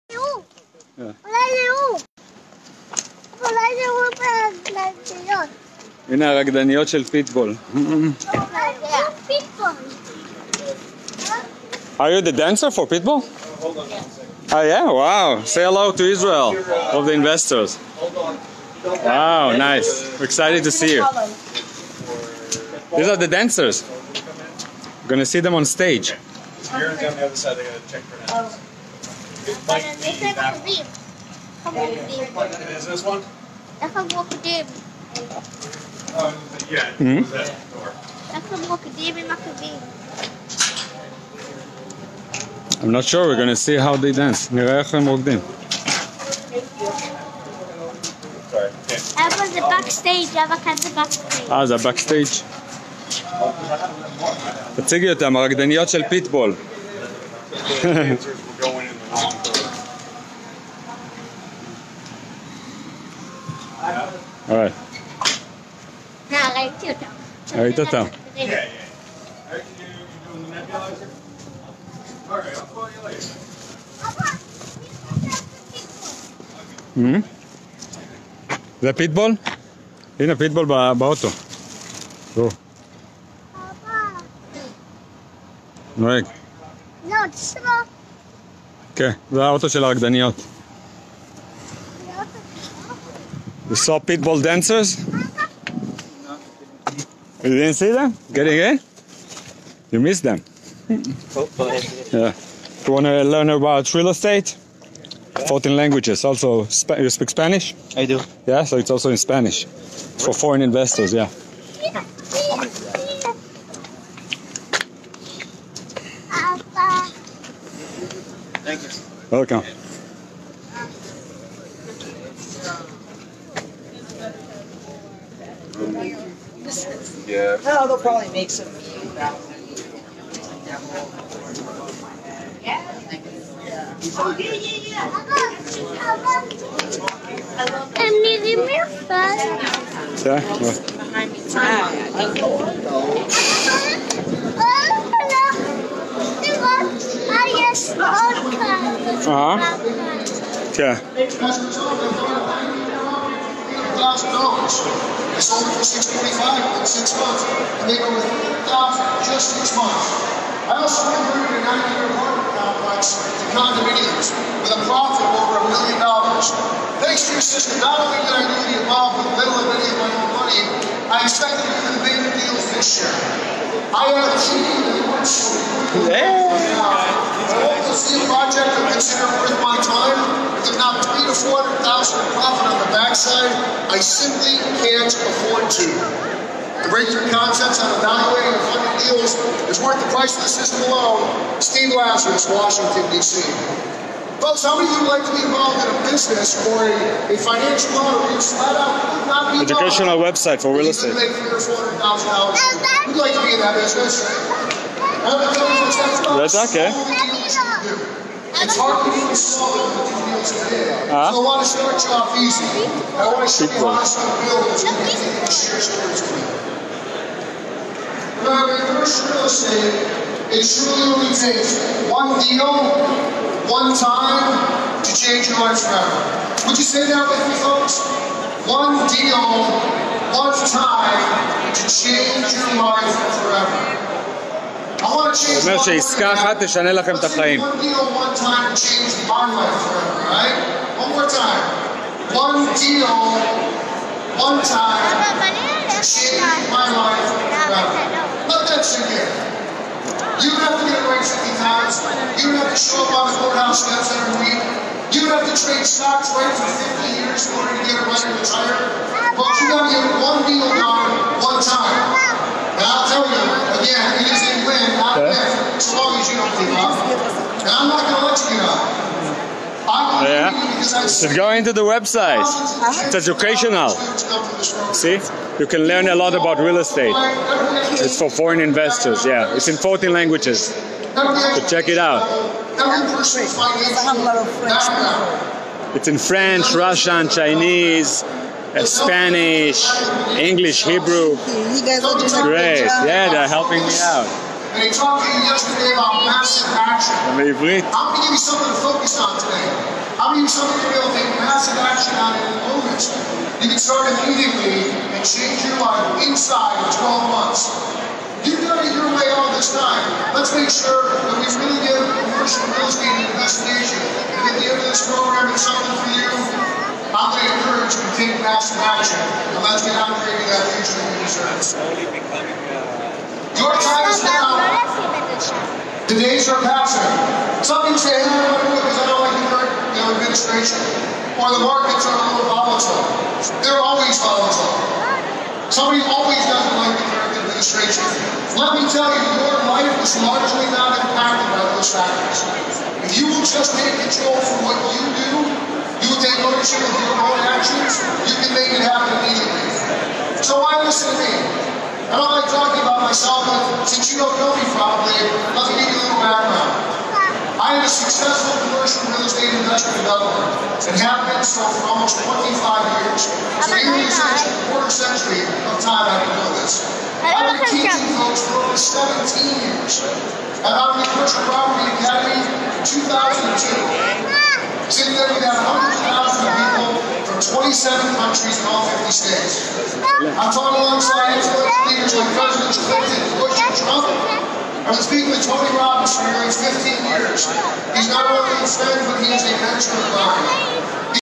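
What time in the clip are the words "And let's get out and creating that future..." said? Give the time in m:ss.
5:19.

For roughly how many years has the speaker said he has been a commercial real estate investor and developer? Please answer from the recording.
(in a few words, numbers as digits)
25.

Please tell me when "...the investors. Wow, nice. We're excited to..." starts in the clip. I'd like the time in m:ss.
0:17.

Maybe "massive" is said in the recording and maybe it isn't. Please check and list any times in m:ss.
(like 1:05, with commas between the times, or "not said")
4:56, 5:01, 5:18.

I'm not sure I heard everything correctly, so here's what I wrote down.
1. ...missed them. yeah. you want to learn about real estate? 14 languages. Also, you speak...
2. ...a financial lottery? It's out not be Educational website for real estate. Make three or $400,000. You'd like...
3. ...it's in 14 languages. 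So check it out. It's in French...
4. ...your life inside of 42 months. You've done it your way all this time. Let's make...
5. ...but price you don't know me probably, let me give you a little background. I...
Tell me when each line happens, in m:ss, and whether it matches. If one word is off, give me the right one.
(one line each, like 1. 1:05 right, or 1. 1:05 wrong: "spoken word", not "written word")
1. 1:40 right
2. 3:17 right
3. 4:39 right
4. 5:05 wrong: "12", not "42"
5. 5:53 wrong: "since", not "price".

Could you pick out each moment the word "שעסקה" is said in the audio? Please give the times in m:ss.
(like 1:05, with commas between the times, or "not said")
3:55.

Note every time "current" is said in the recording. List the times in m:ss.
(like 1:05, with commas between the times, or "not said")
5:29, 5:37.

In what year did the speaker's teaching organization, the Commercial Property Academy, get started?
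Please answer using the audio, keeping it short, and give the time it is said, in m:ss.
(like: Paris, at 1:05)
2002, at 6:12.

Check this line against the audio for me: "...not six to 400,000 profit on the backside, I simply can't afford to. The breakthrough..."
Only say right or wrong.
wrong.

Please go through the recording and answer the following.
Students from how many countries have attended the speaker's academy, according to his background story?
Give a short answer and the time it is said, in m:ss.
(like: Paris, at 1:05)
27, at 6:17.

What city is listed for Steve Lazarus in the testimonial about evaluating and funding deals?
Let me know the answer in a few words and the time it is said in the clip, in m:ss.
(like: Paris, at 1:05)
Washington, D.C., at 3:12.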